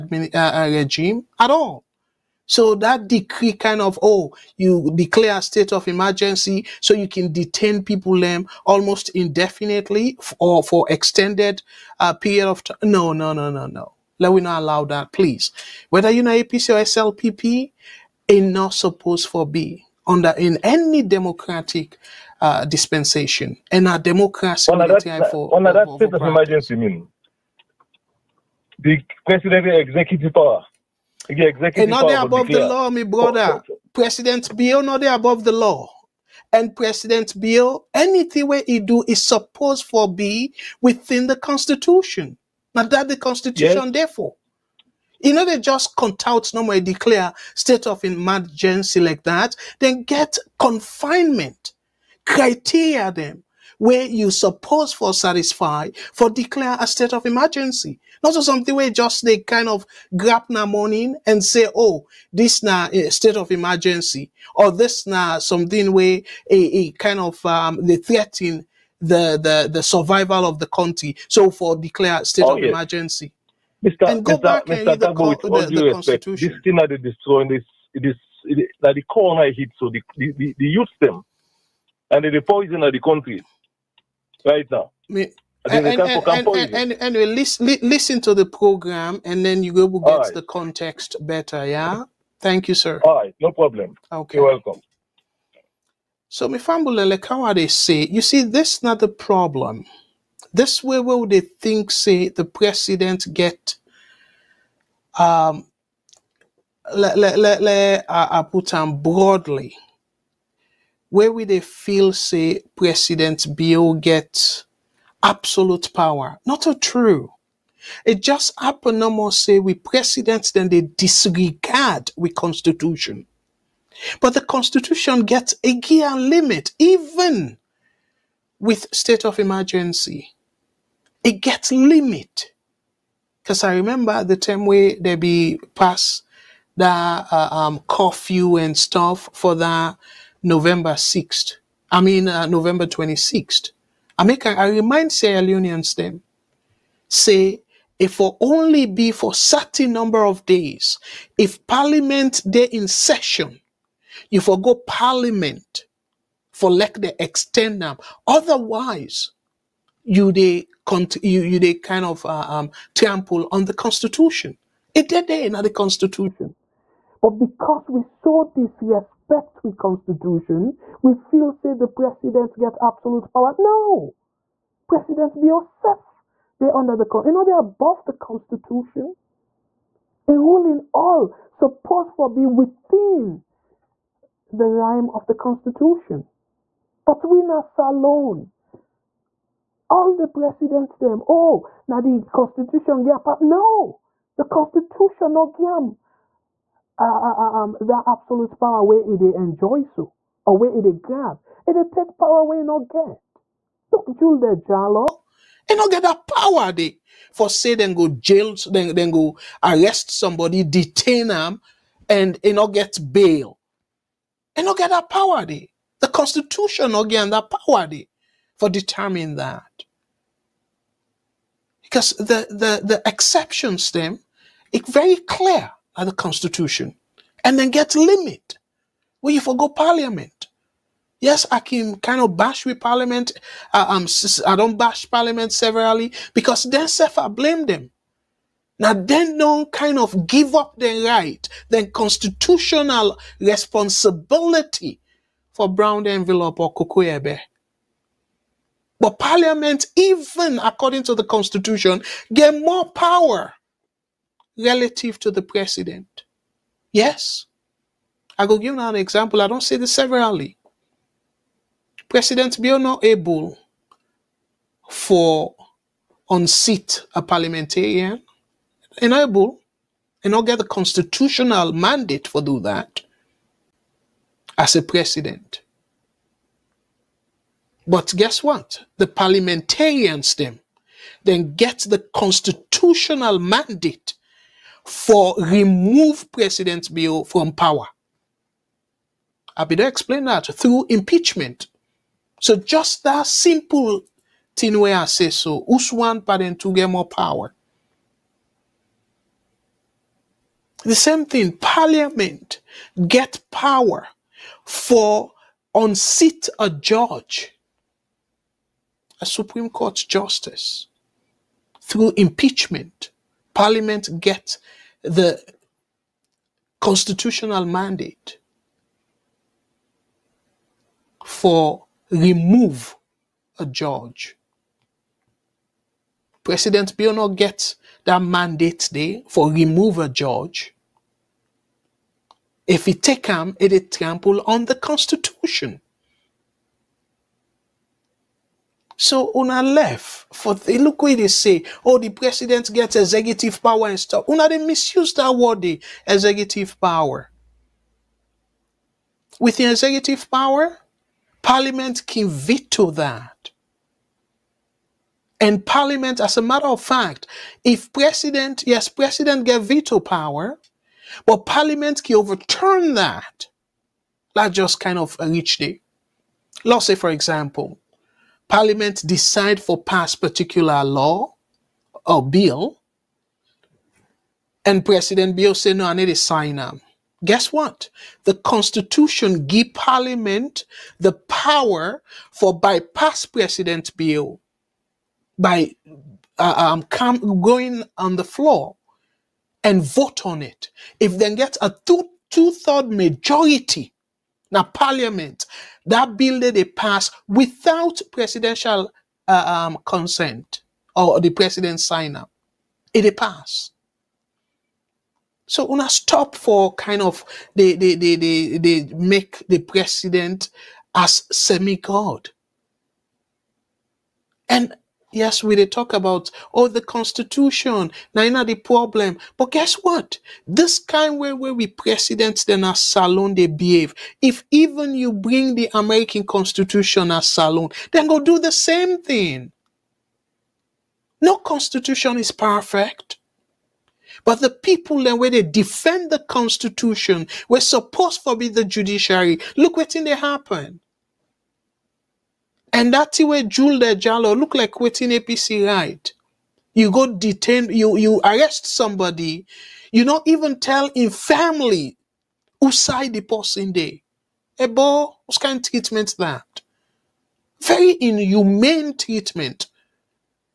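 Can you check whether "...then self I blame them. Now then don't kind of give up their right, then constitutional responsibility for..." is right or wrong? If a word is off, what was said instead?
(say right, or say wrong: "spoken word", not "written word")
right.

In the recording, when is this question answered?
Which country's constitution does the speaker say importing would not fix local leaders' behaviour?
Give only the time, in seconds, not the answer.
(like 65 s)
425 s.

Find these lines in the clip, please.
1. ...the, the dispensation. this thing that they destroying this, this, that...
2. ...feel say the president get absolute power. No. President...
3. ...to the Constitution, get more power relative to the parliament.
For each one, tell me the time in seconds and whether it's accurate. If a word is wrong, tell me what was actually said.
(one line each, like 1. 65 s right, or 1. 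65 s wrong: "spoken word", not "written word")
1. 75 s wrong: "constitution", not "dispensation"
2. 171 s right
3. 251 s wrong: "president", not "parliament".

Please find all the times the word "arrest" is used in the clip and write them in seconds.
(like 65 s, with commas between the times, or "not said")
209 s, 448 s.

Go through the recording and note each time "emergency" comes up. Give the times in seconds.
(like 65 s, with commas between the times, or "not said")
5 s, 26 s, 48 s, 57 s, 63 s, 72 s, 129 s.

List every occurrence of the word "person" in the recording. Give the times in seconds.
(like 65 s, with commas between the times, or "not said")
453 s.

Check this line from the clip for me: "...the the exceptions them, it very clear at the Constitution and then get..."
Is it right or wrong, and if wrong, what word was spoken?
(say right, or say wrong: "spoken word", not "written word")
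right.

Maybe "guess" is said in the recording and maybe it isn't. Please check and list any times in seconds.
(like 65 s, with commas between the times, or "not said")
278 s, 377 s, 419 s.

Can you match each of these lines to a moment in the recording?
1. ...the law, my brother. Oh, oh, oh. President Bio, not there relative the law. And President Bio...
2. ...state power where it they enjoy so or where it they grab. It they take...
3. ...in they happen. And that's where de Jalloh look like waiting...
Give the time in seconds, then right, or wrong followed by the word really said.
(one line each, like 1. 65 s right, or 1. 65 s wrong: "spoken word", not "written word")
1. 32 s wrong: "above", not "relative"
2. 198 s wrong: "absolute", not "state"
3. 439 s right.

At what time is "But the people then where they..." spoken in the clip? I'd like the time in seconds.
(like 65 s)
434 s.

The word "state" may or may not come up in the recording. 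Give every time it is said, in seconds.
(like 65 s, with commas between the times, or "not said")
5 s, 25 s, 47 s, 56 s, 63 s, 72 s, 128 s.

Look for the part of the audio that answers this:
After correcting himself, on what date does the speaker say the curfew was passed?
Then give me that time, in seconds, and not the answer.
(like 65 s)
142 s.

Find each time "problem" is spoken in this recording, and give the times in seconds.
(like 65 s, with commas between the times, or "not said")
93 s, 99 s, 418 s.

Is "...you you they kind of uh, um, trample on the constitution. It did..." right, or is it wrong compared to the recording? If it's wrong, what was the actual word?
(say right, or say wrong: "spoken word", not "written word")
right.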